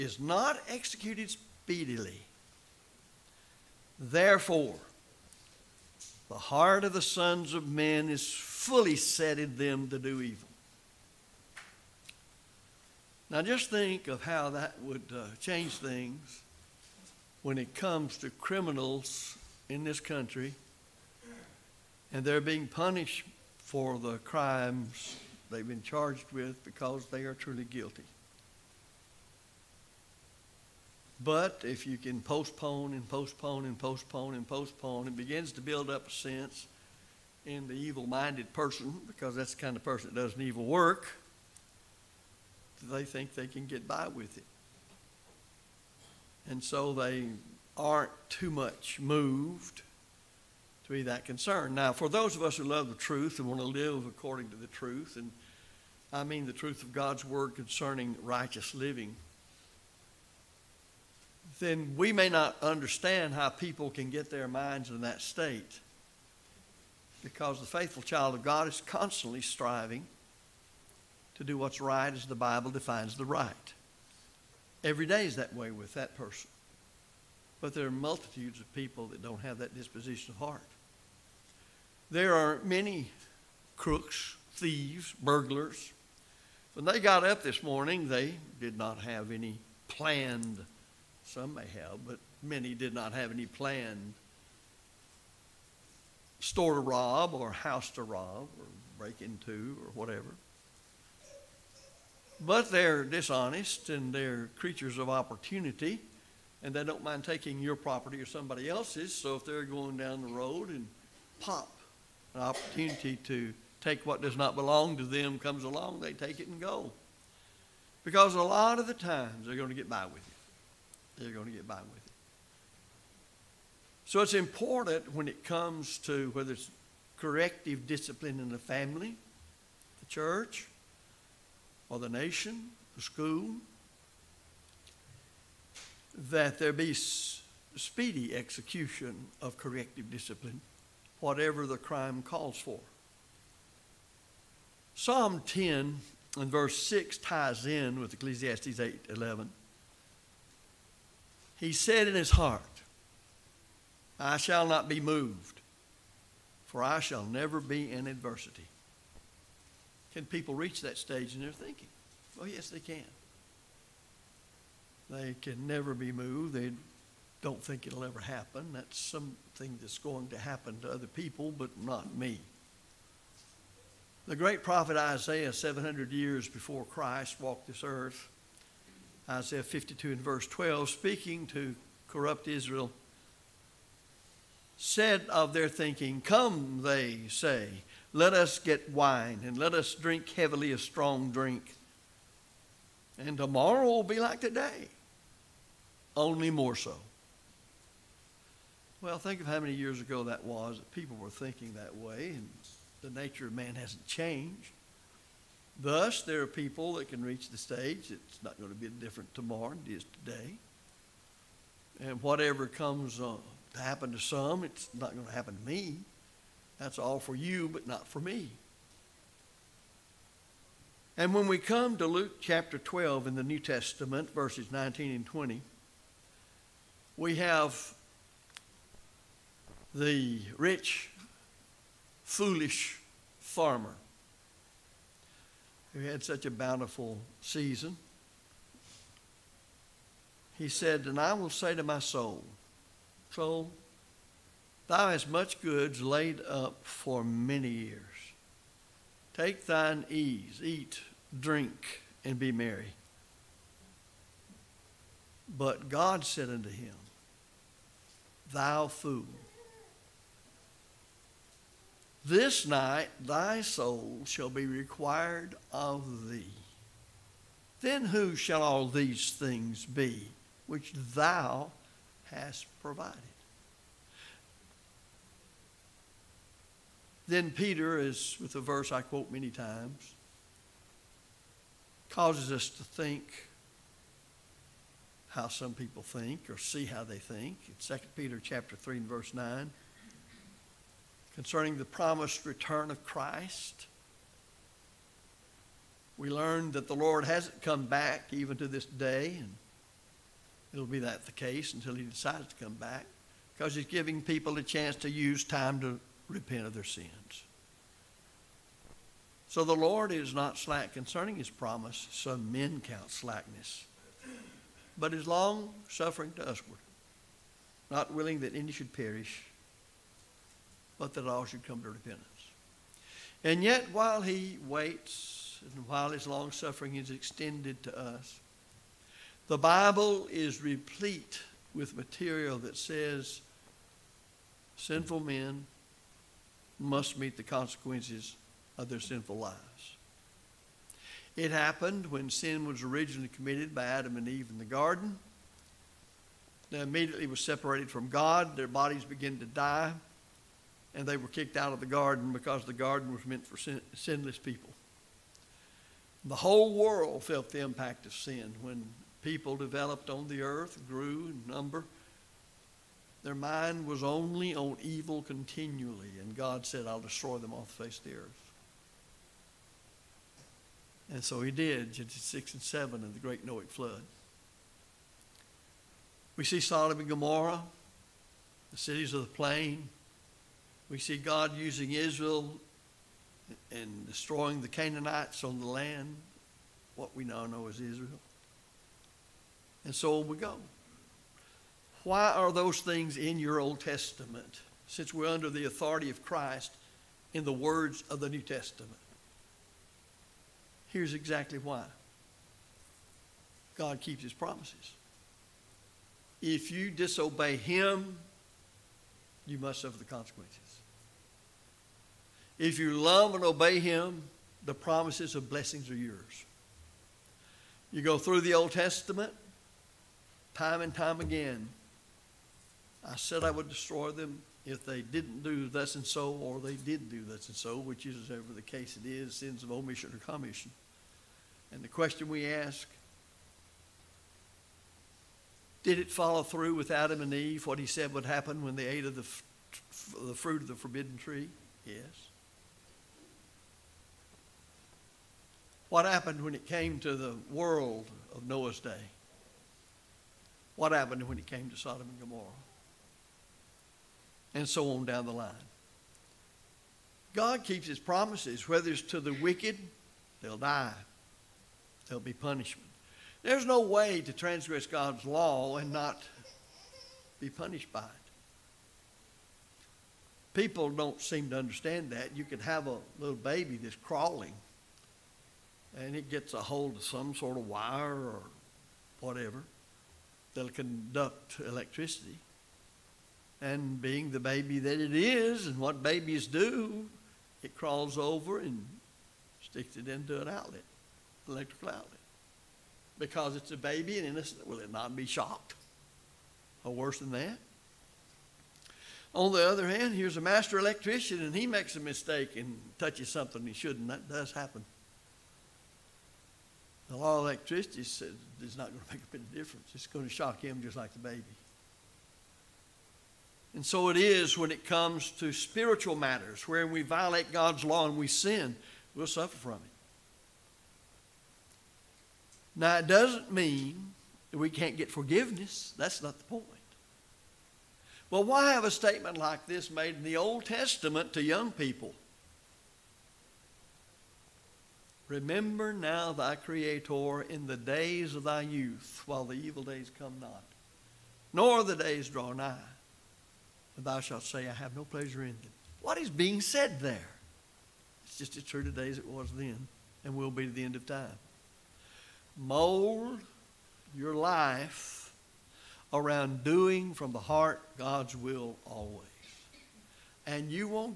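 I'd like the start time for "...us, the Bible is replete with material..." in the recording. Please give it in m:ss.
5:27.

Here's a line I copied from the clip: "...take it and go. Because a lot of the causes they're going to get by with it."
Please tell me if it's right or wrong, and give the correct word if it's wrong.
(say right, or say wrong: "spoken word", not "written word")
wrong: "times", not "causes".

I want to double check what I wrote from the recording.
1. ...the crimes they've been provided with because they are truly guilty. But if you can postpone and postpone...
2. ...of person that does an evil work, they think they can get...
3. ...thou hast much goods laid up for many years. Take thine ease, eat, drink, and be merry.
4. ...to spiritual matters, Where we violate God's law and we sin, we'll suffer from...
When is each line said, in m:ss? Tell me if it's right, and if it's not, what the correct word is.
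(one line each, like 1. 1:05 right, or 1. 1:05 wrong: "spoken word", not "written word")
1. 0:23 wrong: "charged", not "provided"
2. 0:39 right
3. 4:04 right
4. 8:35 right.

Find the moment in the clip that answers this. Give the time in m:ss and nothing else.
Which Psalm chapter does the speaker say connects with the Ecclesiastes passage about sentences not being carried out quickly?
2:24.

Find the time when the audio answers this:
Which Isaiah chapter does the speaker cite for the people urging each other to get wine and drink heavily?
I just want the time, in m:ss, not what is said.
2:59.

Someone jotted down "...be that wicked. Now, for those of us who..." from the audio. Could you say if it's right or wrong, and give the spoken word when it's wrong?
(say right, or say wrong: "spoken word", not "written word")
wrong: "concerned", not "wicked".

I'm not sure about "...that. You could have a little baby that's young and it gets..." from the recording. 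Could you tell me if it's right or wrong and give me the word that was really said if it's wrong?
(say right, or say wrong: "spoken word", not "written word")
wrong: "crawling", not "young".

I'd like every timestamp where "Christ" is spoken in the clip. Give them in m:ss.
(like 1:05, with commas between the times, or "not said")
2:56, 4:53, 6:36.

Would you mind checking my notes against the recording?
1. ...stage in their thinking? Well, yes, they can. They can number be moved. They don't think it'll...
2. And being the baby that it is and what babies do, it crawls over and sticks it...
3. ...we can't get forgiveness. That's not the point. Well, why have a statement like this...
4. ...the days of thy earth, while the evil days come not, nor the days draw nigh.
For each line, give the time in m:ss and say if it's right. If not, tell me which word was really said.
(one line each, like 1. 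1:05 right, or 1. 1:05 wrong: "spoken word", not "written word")
1. 2:40 wrong: "never", not "number"
2. 8:03 right
3. 8:44 right
4. 8:57 wrong: "youth", not "earth".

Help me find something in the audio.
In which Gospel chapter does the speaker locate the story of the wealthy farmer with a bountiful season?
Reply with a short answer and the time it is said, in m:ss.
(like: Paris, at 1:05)
Luke chapter 12, at 3:42.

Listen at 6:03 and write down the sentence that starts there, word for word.
Their mind was only on evil continually, and God said, I'll destroy them off the face of the earth.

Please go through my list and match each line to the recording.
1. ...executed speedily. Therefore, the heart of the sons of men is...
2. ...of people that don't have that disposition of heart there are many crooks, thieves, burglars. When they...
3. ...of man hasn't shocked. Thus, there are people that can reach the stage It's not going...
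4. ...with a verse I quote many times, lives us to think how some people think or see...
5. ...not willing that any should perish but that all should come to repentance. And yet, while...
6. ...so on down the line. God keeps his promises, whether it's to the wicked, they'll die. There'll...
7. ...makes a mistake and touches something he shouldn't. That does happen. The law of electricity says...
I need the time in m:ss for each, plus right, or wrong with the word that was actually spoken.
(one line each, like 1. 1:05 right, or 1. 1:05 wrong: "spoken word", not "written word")
1. 0:00 right
2. 1:18 right
3. 3:23 wrong: "changed", not "shocked"
4. 4:38 wrong: "causes", not "lives"
5. 5:17 right
6. 7:34 right
7. 8:21 right.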